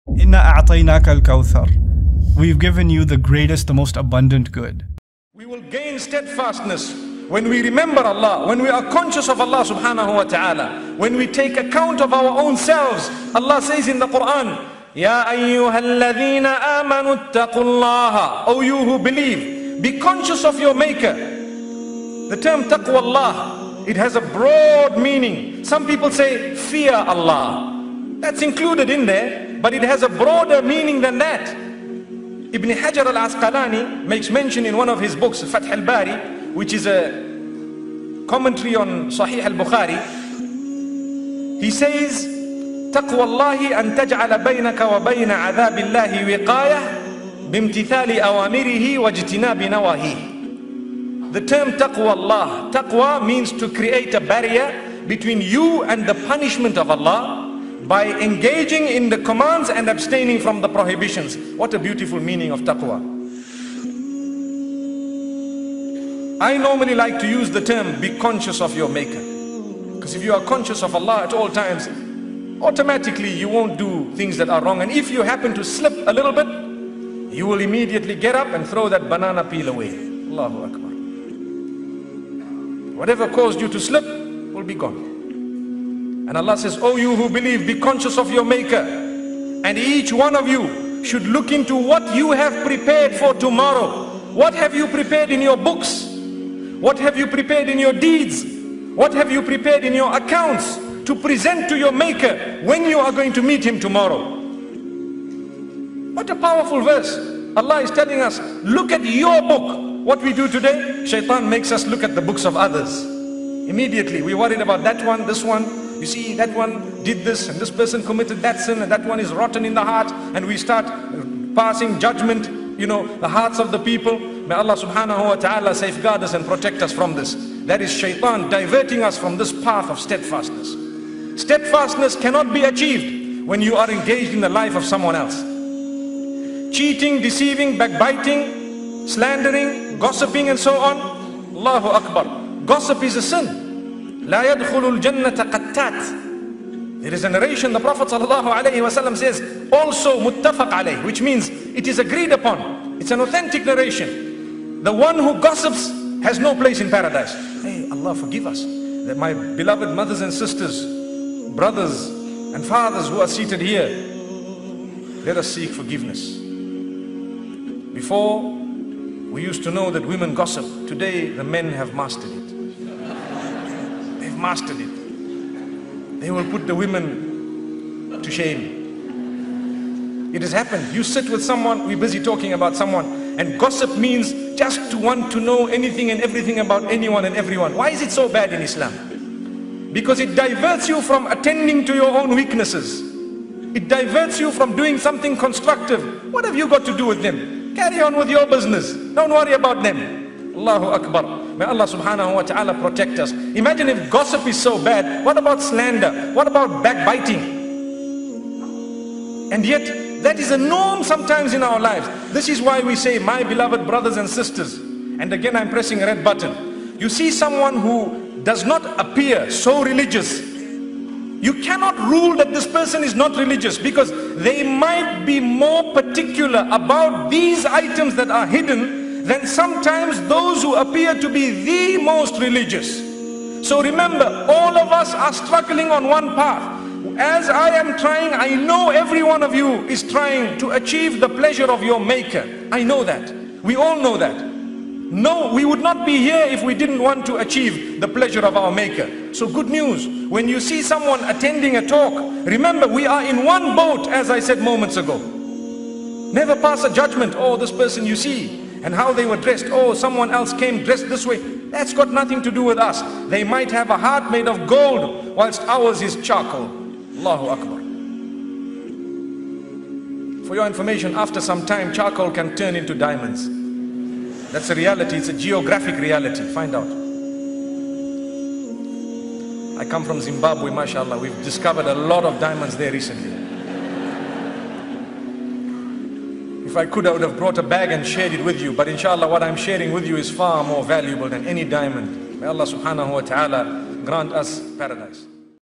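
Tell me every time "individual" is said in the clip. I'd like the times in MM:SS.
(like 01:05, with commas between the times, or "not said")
not said.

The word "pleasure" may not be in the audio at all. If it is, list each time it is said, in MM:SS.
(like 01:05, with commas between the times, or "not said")
04:01, 04:08.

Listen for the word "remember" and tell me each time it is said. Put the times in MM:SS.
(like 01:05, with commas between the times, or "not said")
00:07, 03:53, 04:12.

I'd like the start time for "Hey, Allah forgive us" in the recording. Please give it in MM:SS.
02:37.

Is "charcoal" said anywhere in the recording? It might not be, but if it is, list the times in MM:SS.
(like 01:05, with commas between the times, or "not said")
04:26, 04:31.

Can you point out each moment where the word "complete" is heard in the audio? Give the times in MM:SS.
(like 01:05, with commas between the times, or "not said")
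not said.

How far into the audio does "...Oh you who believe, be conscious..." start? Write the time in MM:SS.
01:26.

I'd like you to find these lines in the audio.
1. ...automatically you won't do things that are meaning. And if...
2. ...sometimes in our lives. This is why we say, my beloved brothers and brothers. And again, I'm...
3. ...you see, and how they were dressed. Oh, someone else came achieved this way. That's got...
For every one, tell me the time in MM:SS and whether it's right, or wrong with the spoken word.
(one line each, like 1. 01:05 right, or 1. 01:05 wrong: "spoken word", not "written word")
1. 01:12 wrong: "wrong", not "meaning"
2. 03:31 wrong: "sisters", not "brothers"
3. 04:18 wrong: "dressed", not "achieved".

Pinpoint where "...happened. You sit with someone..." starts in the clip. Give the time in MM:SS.
03:00.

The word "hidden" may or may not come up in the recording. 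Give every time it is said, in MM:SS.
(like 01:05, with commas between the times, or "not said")
03:48.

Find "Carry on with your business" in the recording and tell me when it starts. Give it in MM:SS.
03:17.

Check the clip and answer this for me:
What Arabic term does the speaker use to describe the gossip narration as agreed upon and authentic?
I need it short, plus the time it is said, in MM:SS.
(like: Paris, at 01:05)
muttafaq alayhi, at 02:30.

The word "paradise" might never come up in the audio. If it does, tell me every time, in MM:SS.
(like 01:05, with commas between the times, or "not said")
02:36, 04:54.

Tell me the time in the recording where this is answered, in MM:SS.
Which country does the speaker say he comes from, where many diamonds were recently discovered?
04:40.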